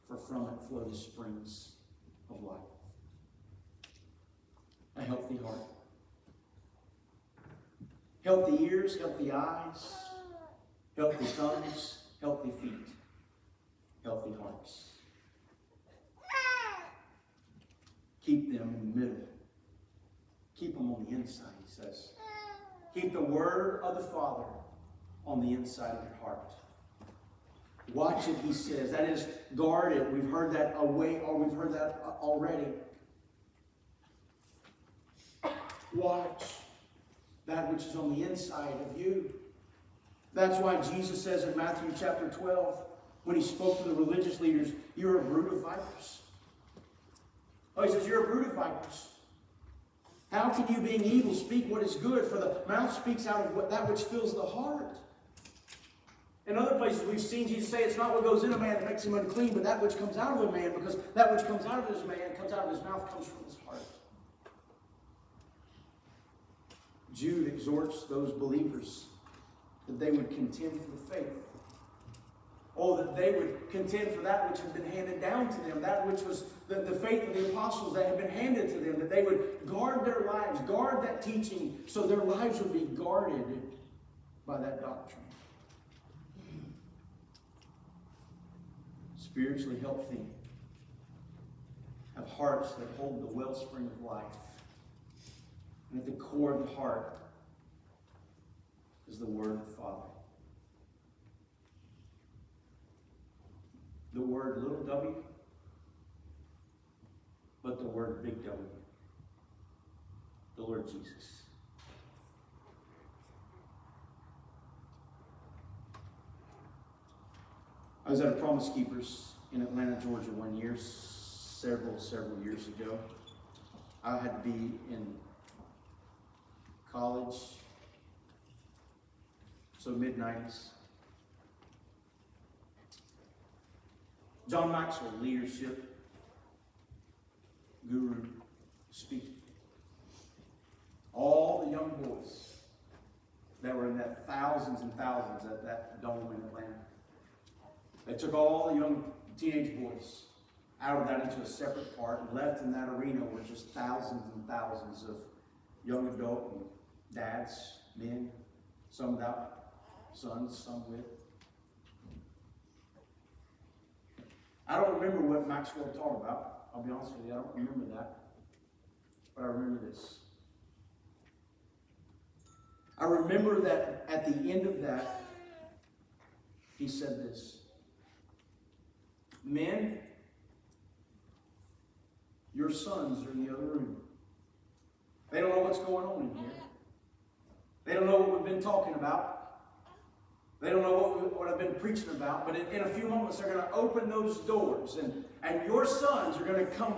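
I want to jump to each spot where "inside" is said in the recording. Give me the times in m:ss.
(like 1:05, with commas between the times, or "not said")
0:21, 0:25, 0:38.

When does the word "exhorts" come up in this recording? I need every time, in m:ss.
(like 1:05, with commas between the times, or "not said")
1:07.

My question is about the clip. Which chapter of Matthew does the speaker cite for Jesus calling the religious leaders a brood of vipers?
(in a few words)
12.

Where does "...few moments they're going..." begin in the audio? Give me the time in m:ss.
3:12.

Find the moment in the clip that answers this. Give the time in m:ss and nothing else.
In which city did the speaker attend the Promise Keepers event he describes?
1:59.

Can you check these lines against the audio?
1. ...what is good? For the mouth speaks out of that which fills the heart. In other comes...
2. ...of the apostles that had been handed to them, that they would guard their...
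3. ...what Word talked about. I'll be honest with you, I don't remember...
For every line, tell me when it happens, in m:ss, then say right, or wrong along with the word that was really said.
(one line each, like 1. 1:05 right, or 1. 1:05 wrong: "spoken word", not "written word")
1. 0:51 wrong: "places", not "comes"
2. 1:17 right
3. 2:45 wrong: "Maxwell", not "Word".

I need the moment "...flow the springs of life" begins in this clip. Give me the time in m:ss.
0:00.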